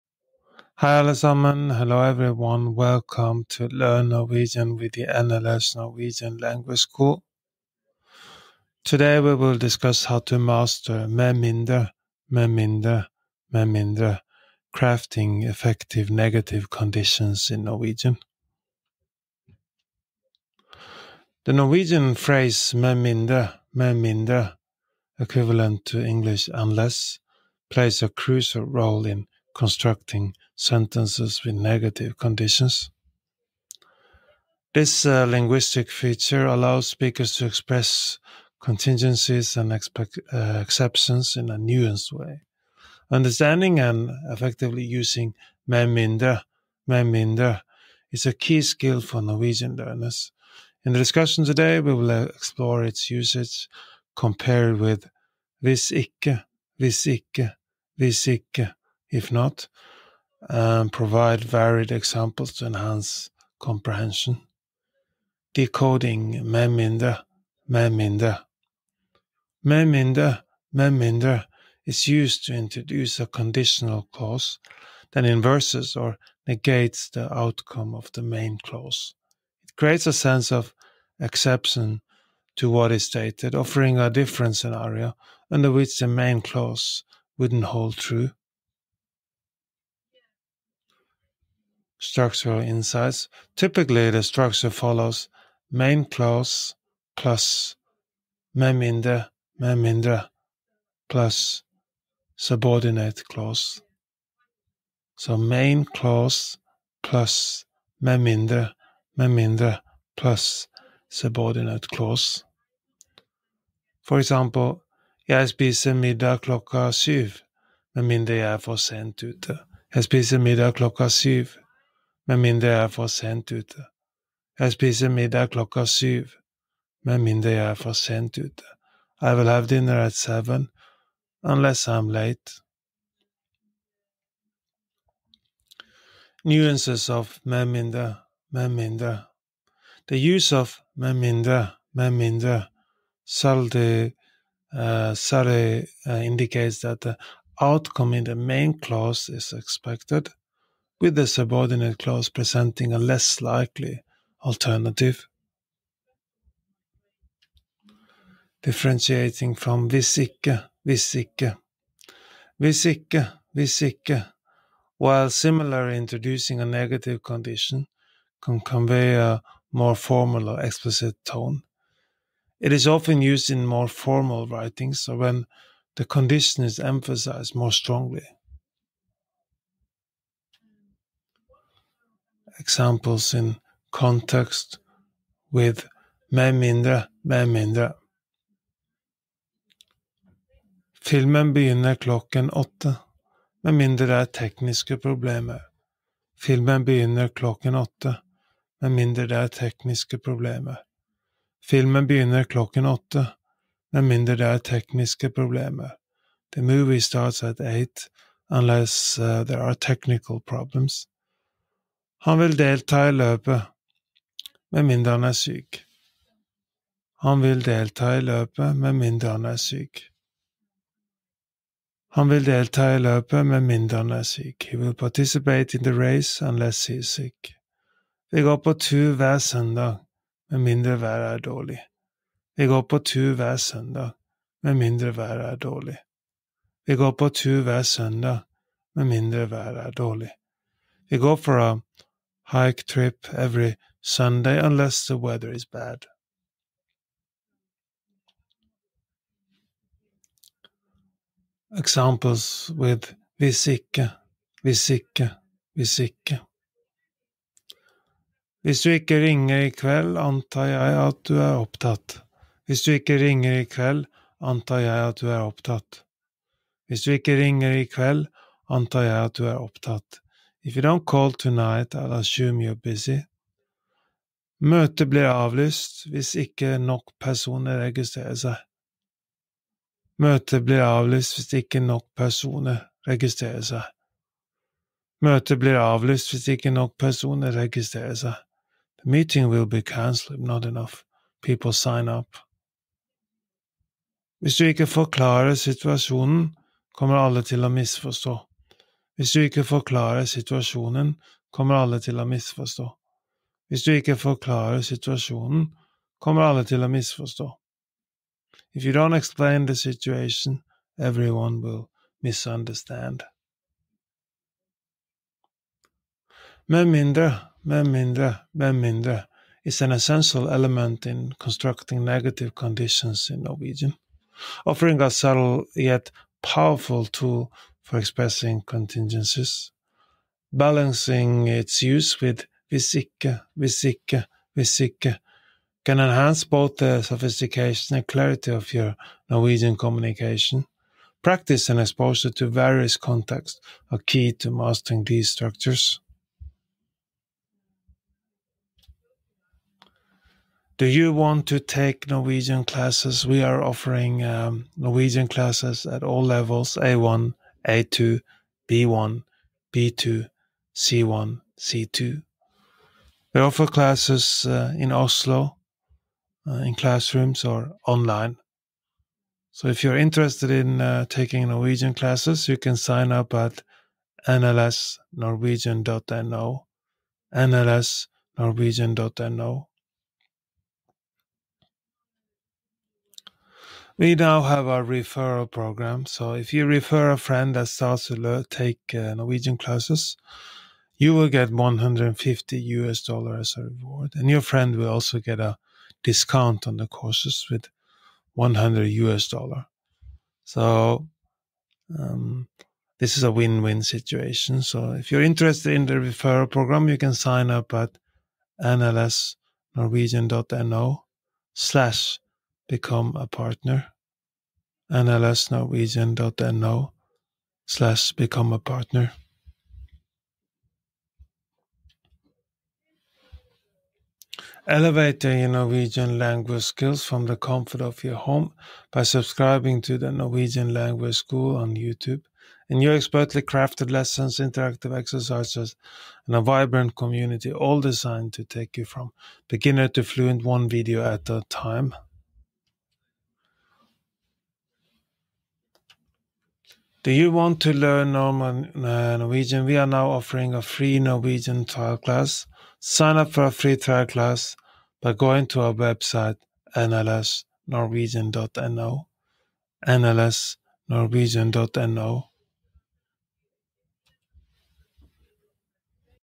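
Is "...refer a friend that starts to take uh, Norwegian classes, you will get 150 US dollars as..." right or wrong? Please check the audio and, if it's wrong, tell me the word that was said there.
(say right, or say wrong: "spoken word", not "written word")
right.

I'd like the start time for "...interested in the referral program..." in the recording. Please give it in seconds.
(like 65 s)
405 s.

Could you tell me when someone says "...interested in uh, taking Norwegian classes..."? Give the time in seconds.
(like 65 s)
369 s.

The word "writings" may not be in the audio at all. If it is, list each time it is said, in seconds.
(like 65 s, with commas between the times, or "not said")
174 s.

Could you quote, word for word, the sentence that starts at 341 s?
Practice and exposure to various contexts are key to mastering these structures.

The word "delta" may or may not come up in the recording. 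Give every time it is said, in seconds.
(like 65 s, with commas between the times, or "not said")
212 s, 217 s, 222 s.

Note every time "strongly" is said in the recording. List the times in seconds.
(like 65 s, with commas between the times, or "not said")
177 s.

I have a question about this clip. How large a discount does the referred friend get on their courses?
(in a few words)
100 US dollars.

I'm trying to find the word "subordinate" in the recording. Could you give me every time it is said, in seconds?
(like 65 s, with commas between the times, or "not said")
102 s, 111 s, 151 s.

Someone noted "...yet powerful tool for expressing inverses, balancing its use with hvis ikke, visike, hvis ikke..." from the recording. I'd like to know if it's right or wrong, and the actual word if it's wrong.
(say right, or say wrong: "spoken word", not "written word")
wrong: "contingencies", not "inverses".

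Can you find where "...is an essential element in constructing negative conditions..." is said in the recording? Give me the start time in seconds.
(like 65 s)
319 s.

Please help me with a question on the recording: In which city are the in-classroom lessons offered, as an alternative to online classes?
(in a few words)
Oslo.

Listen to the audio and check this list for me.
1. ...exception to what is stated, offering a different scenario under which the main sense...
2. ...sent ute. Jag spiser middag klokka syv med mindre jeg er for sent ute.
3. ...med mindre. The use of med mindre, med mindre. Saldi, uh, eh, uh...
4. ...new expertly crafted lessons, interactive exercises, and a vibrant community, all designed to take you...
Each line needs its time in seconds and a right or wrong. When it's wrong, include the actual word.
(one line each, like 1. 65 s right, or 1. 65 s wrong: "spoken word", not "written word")
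1. 81 s wrong: "clause", not "sense"
2. 118 s right
3. 138 s right
4. 432 s right.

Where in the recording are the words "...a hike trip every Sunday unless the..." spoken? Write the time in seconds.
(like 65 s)
241 s.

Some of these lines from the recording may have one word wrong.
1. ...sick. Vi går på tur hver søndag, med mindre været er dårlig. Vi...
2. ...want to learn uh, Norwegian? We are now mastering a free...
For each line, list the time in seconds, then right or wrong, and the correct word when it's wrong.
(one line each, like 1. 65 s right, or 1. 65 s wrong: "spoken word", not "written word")
1. 227 s right
2. 447 s wrong: "offering", not "mastering".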